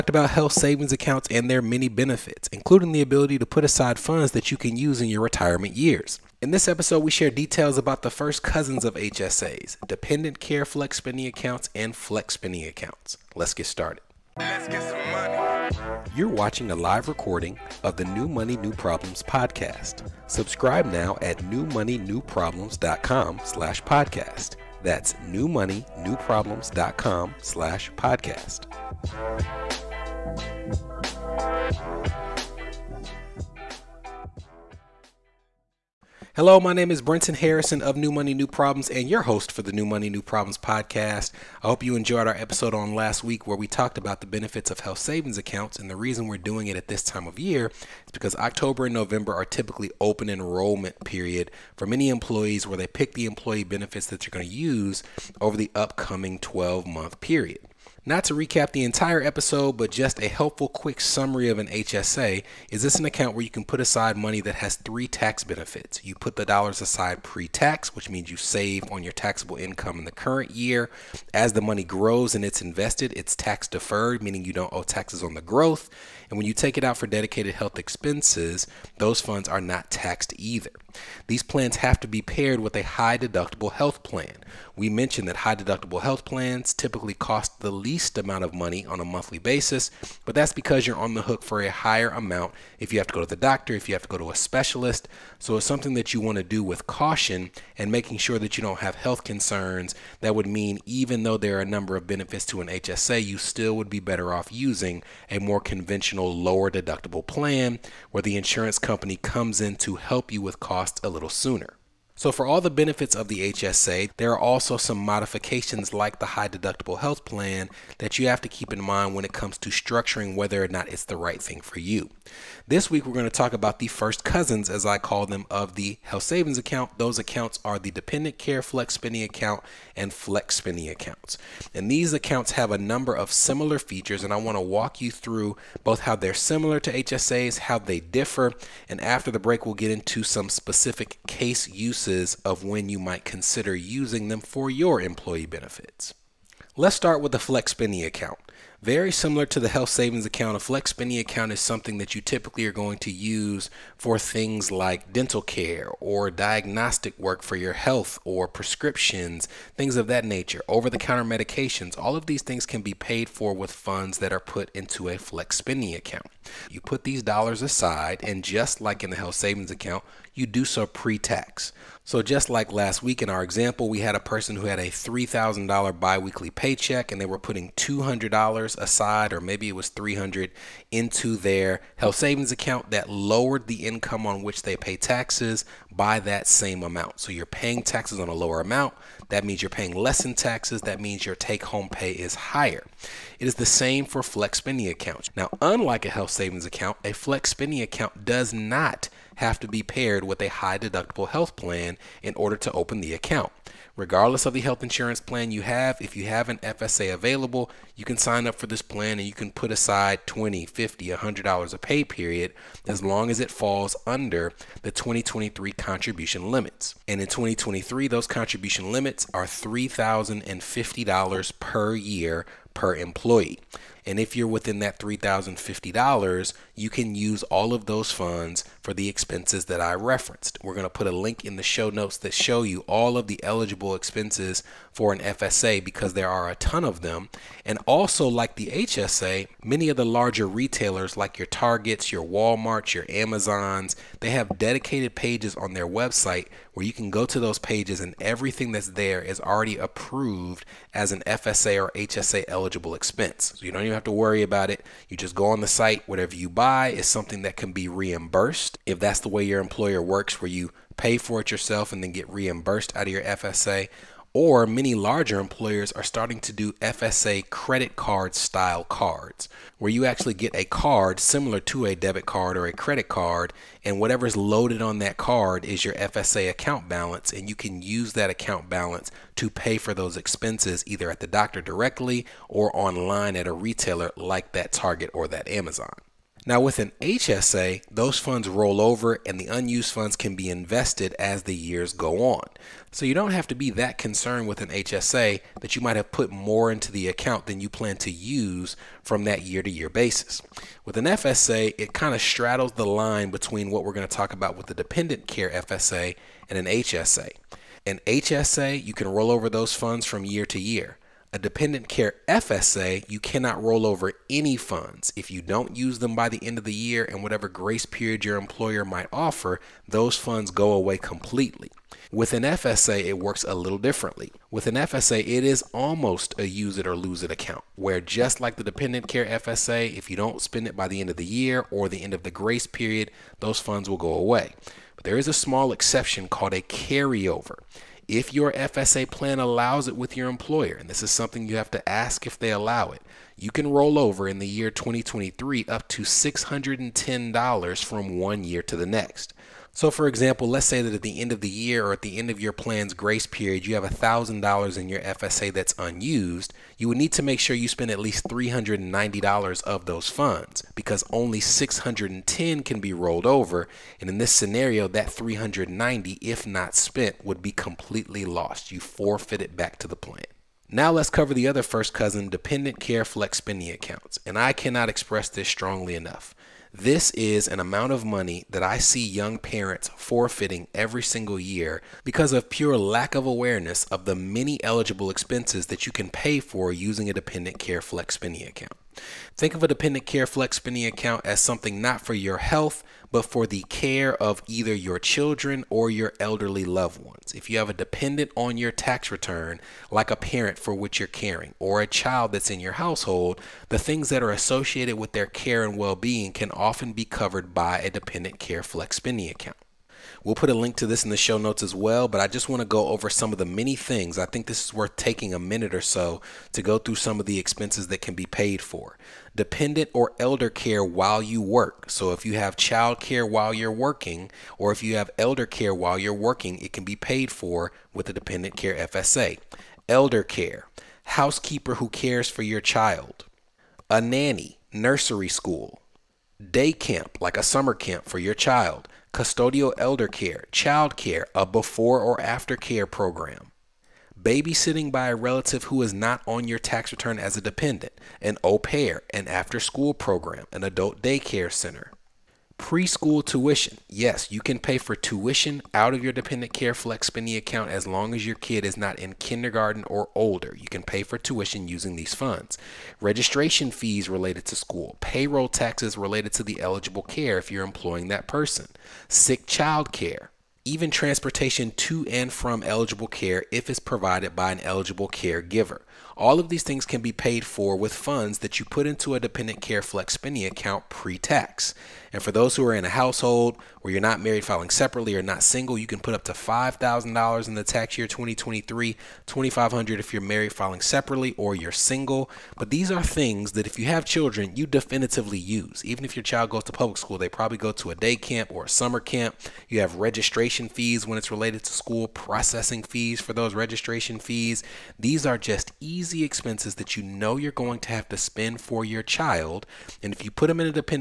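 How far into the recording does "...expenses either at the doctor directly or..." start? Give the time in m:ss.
4:40.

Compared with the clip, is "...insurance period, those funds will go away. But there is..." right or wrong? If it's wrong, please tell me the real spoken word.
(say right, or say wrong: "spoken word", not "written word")
wrong: "grace", not "insurance".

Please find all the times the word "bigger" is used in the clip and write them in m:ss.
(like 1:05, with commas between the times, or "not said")
not said.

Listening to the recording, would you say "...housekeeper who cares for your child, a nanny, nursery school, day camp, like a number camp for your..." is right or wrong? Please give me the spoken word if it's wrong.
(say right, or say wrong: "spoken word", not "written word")
wrong: "summer", not "number".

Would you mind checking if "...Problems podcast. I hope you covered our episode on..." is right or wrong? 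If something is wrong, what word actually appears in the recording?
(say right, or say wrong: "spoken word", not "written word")
wrong: "enjoyed", not "covered".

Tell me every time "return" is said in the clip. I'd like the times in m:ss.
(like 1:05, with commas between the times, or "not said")
6:39, 7:26.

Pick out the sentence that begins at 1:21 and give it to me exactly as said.
These plans have to be paired with a high deductible health plan.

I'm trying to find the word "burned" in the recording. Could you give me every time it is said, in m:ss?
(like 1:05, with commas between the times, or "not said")
not said.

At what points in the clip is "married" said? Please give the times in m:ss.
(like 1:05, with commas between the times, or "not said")
8:04, 8:10.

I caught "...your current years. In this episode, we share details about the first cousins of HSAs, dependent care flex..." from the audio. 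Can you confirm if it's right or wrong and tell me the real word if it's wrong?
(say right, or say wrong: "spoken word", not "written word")
wrong: "retirement", not "current".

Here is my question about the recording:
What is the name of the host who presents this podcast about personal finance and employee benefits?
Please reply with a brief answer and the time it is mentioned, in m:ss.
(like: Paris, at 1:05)
Brenton Harrison, at 0:37.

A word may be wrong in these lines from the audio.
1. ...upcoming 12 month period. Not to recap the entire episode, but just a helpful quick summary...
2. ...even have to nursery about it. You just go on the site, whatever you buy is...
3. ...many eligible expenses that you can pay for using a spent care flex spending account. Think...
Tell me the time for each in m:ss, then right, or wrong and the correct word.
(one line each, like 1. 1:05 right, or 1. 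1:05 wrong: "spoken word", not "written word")
1. 0:55 right
2. 4:13 wrong: "worry", not "nursery"
3. 6:24 wrong: "dependent", not "spent".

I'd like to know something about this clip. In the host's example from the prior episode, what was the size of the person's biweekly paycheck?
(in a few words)
$3,000.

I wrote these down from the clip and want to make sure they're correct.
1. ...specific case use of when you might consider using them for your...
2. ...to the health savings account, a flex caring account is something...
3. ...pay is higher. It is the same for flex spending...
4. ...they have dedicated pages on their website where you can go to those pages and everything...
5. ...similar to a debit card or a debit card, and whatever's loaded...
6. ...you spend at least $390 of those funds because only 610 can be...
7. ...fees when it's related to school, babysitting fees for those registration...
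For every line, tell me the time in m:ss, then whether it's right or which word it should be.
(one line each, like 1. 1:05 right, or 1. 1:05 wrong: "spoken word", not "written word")
1. 2:20 right
2. 2:29 wrong: "spending", not "caring"
3. 3:11 right
4. 4:04 right
5. 4:31 wrong: "credit", not "debit"
6. 5:57 right
7. 8:20 wrong: "processing", not "babysitting".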